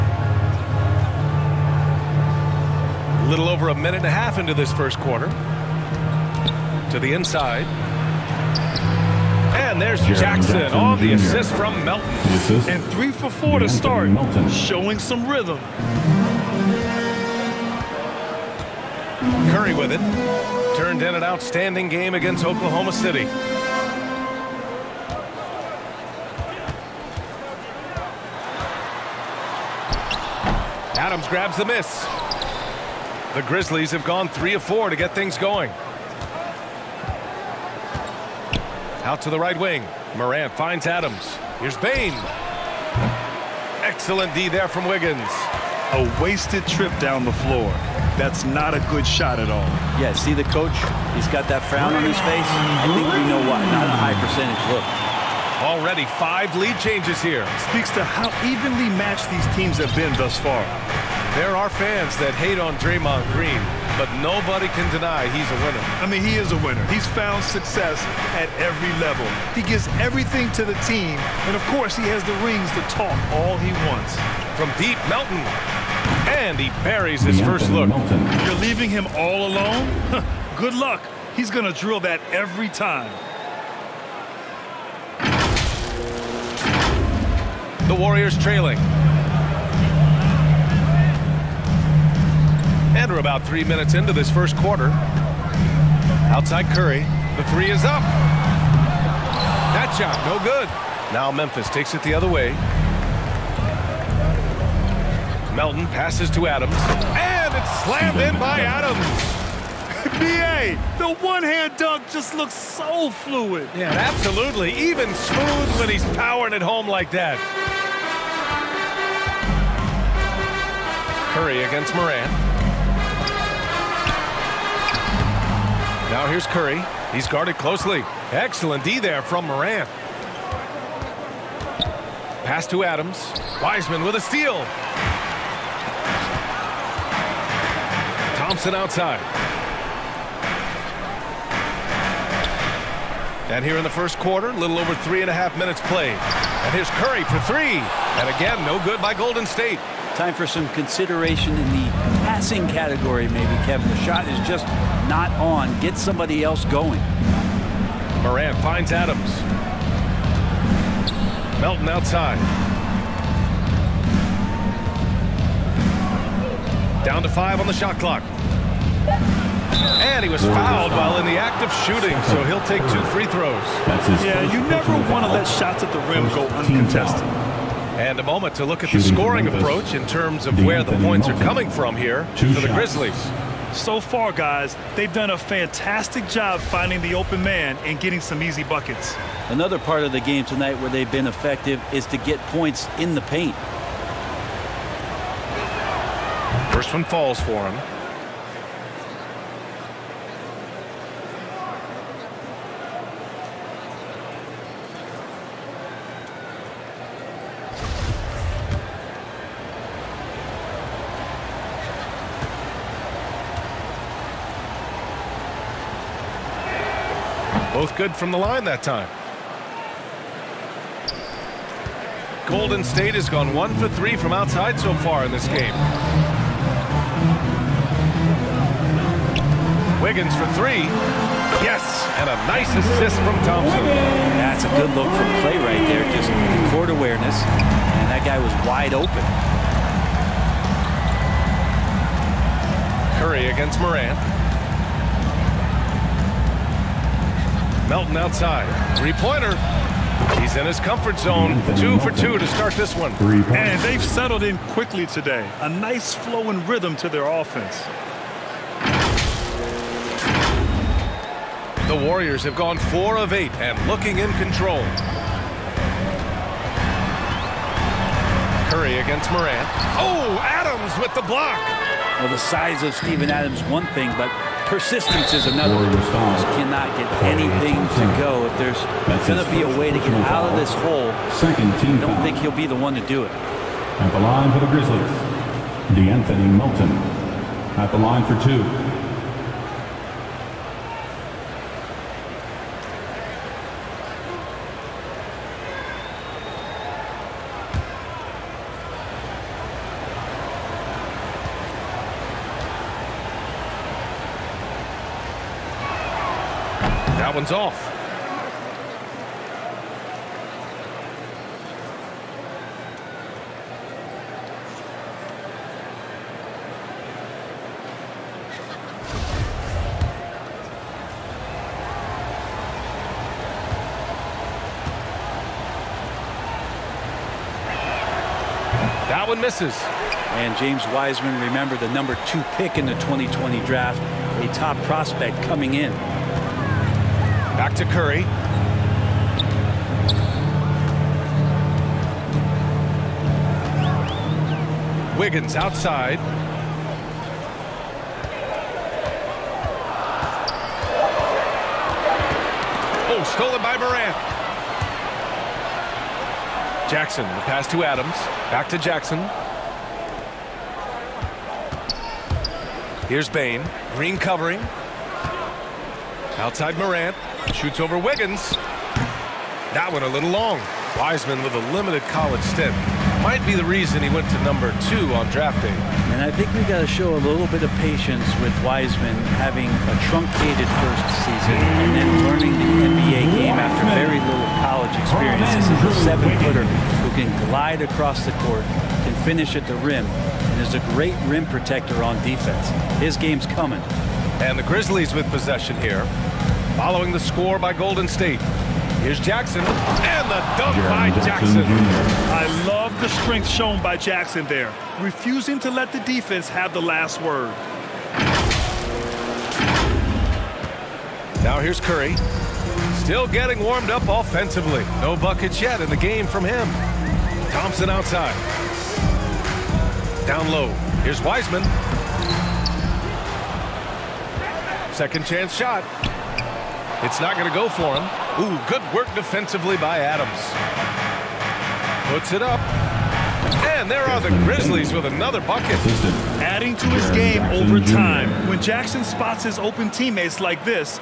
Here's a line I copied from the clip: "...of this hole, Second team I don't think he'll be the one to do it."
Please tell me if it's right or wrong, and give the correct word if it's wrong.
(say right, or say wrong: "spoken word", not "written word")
right.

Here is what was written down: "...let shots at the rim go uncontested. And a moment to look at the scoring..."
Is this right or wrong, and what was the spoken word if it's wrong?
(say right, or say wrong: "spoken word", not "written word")
right.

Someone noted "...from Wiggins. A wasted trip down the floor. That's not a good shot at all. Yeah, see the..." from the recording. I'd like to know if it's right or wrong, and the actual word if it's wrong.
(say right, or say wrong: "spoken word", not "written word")
right.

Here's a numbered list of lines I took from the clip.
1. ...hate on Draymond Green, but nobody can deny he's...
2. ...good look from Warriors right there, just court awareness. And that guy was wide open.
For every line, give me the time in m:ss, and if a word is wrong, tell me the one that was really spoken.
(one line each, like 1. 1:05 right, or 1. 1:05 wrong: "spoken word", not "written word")
1. 1:02 right
2. 3:54 wrong: "Clay", not "Warriors".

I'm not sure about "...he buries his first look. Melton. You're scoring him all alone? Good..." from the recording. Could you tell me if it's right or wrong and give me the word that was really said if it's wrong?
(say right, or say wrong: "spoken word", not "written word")
wrong: "leaving", not "scoring".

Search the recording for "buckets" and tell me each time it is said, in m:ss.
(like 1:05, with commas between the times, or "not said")
3:08, 6:55, 7:15.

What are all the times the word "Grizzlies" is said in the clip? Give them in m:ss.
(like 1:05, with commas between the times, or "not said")
0:33, 3:02, 4:44, 6:34, 7:14.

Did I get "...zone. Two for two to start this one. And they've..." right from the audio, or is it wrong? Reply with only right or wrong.
right.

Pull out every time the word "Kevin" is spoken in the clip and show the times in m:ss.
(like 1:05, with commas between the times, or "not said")
2:33.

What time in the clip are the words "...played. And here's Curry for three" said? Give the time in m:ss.
2:25.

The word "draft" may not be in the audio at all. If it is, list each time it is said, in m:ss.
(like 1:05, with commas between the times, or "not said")
5:33, 6:15.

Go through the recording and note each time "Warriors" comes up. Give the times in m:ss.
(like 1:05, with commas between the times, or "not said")
1:27, 4:22.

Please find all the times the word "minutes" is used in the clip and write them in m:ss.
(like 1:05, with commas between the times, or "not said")
0:03, 1:33, 2:25.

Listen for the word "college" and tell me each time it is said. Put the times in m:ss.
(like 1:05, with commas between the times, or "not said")
6:12, 6:24.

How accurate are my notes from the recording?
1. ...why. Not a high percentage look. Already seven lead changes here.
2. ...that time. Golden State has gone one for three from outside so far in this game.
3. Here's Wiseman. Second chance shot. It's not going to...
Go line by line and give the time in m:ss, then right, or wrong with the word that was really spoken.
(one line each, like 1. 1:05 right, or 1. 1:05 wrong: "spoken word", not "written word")
1. 0:53 wrong: "five", not "seven"
2. 3:38 right
3. 7:01 right.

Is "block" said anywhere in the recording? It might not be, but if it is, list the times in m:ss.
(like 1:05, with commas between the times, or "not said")
4:31.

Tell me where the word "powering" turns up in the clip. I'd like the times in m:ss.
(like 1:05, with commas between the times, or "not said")
1:56.